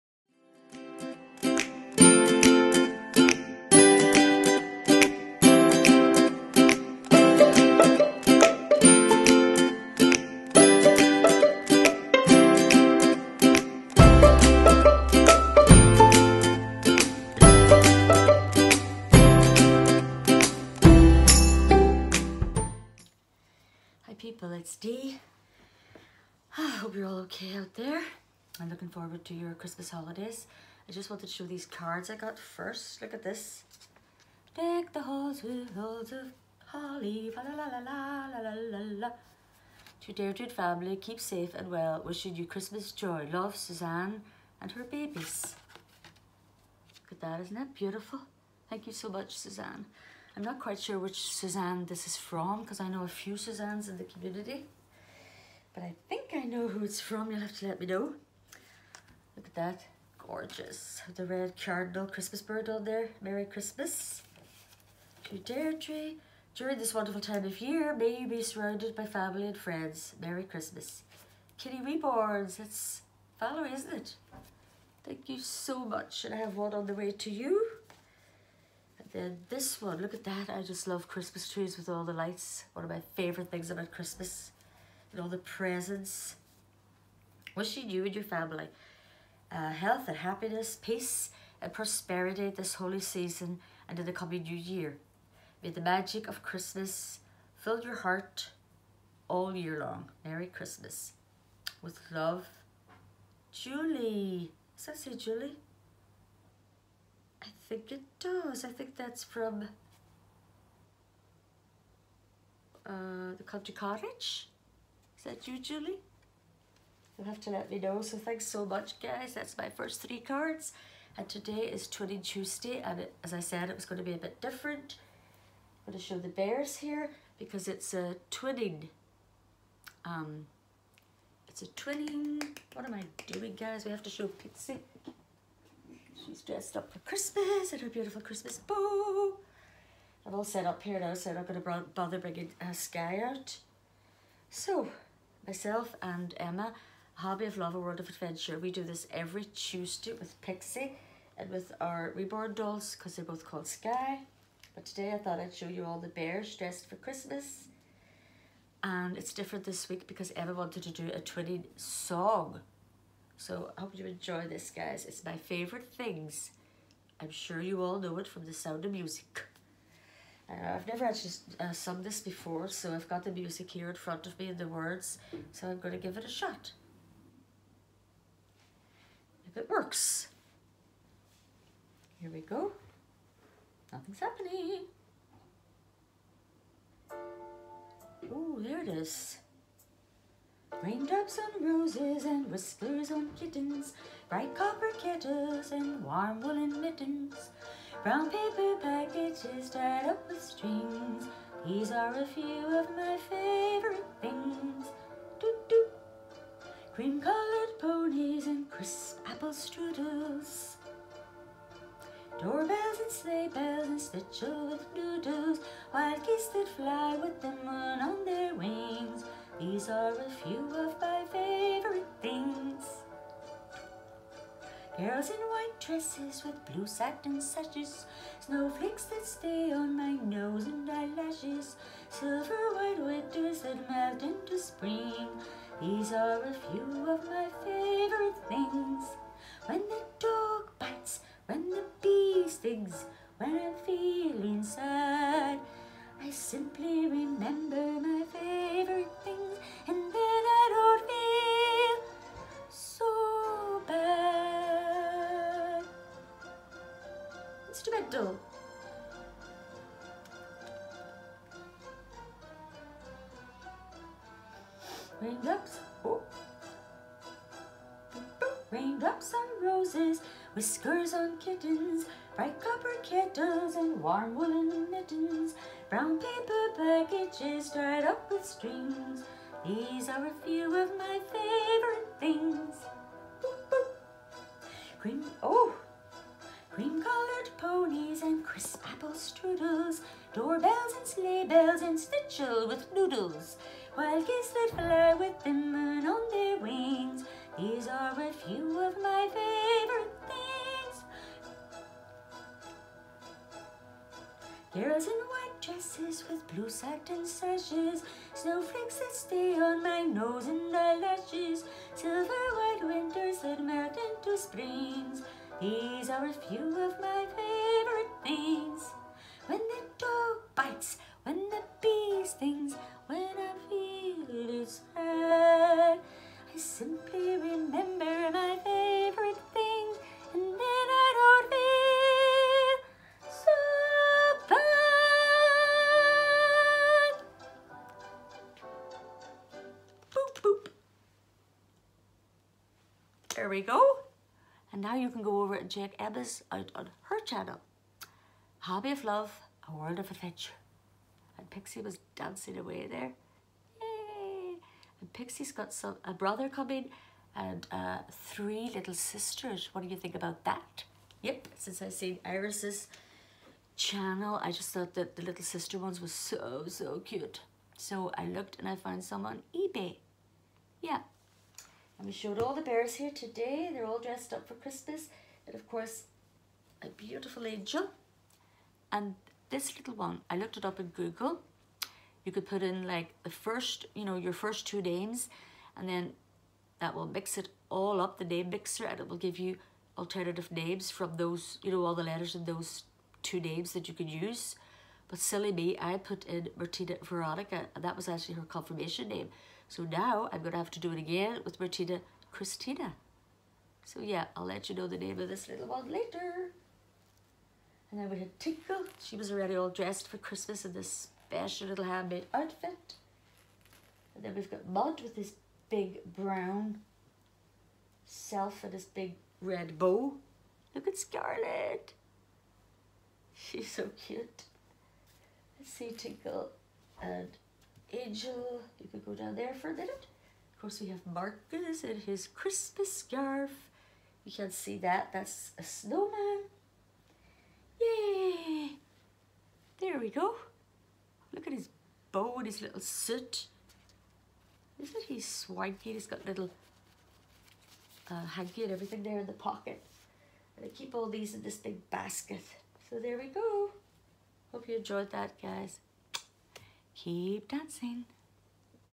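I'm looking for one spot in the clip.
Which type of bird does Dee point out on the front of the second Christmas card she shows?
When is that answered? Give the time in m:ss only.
1:01.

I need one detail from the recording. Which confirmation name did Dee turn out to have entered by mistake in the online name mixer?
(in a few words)
Veronica.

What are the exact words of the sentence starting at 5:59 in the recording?
What do you think about that?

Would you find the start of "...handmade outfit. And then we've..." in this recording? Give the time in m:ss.
6:51.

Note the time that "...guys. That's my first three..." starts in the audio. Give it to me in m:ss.
1:58.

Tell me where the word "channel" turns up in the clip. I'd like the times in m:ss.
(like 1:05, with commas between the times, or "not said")
5:47, 6:03.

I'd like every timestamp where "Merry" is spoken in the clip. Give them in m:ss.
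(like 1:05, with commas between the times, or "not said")
1:03, 1:10, 1:40.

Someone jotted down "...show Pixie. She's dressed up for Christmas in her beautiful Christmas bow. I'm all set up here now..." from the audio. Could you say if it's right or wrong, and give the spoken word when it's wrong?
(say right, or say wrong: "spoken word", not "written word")
right.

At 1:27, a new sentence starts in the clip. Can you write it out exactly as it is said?
Wishing you and your family uh, health and happiness, peace and prosperity this holy season and in the coming new year.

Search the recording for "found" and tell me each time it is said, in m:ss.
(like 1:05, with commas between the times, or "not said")
6:08.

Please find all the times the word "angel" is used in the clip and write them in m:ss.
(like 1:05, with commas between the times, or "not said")
6:17, 7:07.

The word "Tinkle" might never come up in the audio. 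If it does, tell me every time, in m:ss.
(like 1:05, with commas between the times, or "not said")
6:48, 7:05.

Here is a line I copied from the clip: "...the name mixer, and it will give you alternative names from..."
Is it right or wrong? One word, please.
right.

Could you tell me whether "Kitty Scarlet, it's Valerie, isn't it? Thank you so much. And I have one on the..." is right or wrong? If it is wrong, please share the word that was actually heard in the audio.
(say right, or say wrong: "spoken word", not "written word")
wrong: "Reborns", not "Scarlet".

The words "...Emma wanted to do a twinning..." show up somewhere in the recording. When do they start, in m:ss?
2:40.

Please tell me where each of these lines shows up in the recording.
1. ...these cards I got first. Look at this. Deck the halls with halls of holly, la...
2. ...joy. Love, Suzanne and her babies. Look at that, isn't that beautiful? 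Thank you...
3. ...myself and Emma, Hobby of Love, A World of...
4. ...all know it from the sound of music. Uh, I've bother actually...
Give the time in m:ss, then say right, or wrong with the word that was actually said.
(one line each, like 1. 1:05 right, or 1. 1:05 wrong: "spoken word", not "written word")
1. 0:31 right
2. 0:42 right
3. 2:25 right
4. 2:47 wrong: "never", not "bother".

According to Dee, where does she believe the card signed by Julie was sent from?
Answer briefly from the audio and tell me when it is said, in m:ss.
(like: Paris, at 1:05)
The country cottage, at 1:53.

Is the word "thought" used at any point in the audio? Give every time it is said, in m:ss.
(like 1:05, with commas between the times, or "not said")
2:35, 6:04.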